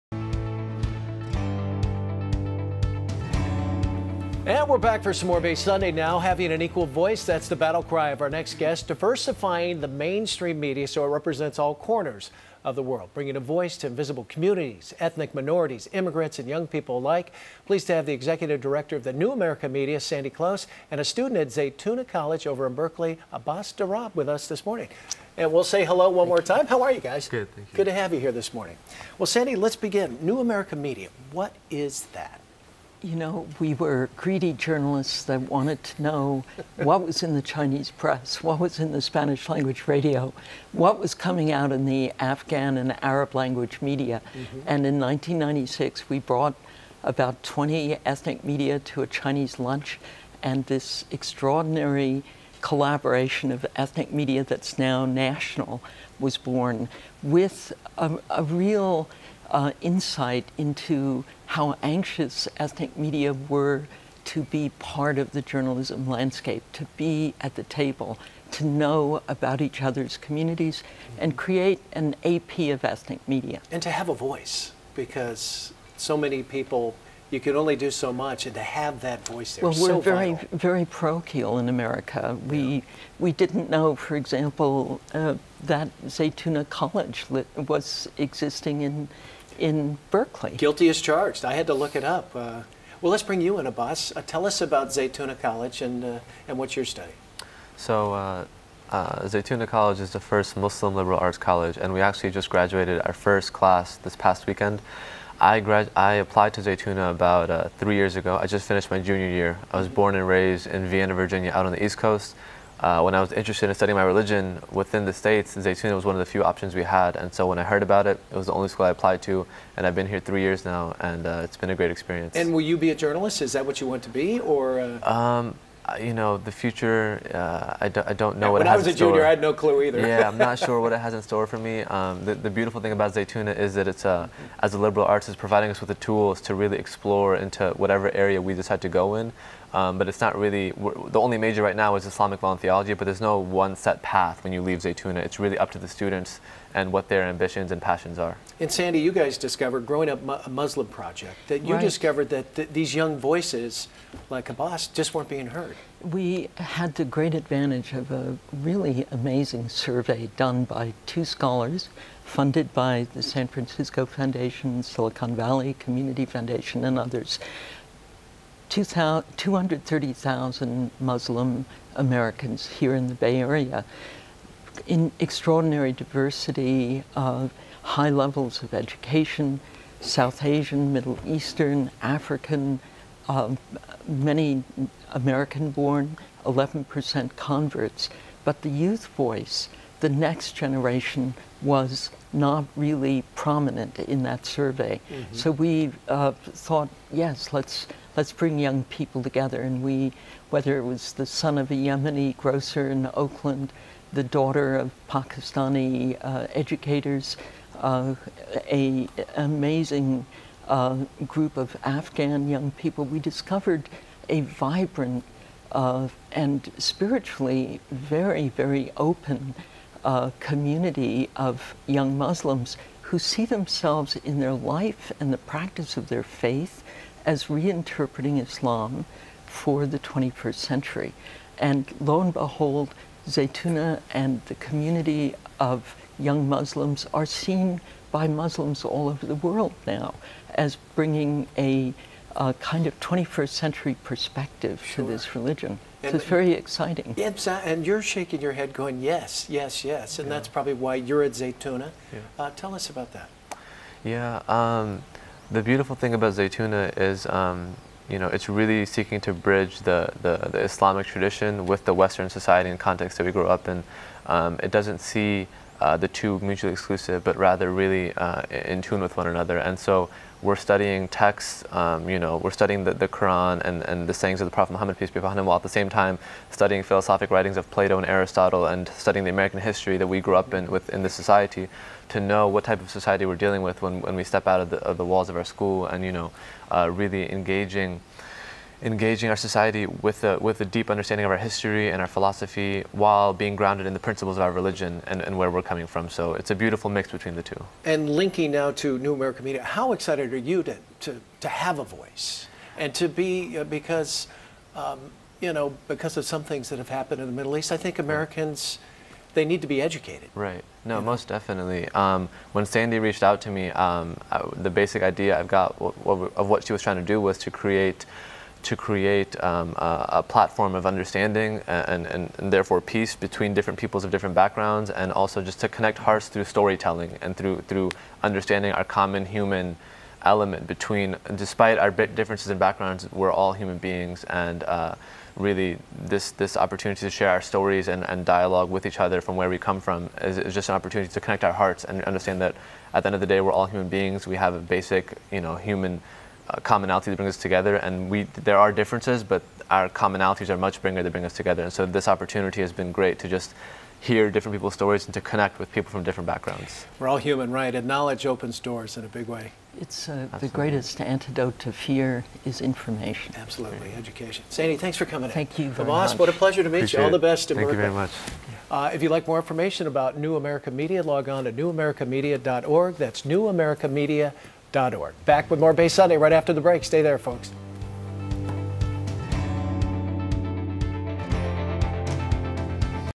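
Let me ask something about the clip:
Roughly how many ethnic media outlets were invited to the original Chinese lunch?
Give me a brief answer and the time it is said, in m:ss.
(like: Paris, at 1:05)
20, at 0:47.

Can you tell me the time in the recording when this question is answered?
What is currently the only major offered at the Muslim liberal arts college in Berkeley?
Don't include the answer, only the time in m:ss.
2:22.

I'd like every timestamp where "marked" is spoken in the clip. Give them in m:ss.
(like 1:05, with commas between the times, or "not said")
not said.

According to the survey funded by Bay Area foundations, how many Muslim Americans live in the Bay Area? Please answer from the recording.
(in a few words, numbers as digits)
230,000.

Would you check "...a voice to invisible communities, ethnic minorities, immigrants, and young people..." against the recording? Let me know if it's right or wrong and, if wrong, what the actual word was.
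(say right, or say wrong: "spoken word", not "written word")
right.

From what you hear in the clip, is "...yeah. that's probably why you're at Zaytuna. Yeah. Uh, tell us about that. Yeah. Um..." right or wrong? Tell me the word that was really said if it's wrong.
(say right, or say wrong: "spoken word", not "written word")
right.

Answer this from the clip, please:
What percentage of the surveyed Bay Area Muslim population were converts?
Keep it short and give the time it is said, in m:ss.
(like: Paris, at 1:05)
11%, at 3:06.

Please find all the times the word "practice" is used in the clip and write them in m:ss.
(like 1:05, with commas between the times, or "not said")
3:45.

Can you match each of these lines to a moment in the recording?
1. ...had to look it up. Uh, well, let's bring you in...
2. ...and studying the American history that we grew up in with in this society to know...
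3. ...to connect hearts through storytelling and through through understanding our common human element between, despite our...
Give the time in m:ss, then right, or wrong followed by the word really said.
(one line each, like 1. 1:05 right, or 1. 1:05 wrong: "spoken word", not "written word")
1. 1:31 right
2. 4:38 right
3. 5:25 right.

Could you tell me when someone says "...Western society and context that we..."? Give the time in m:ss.
4:21.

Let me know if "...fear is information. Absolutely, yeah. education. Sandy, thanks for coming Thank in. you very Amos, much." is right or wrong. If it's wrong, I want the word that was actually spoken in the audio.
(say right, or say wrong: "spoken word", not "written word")
right.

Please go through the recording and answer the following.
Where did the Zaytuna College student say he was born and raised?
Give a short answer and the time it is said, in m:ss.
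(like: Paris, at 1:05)
Vienna, Virginia, at 1:50.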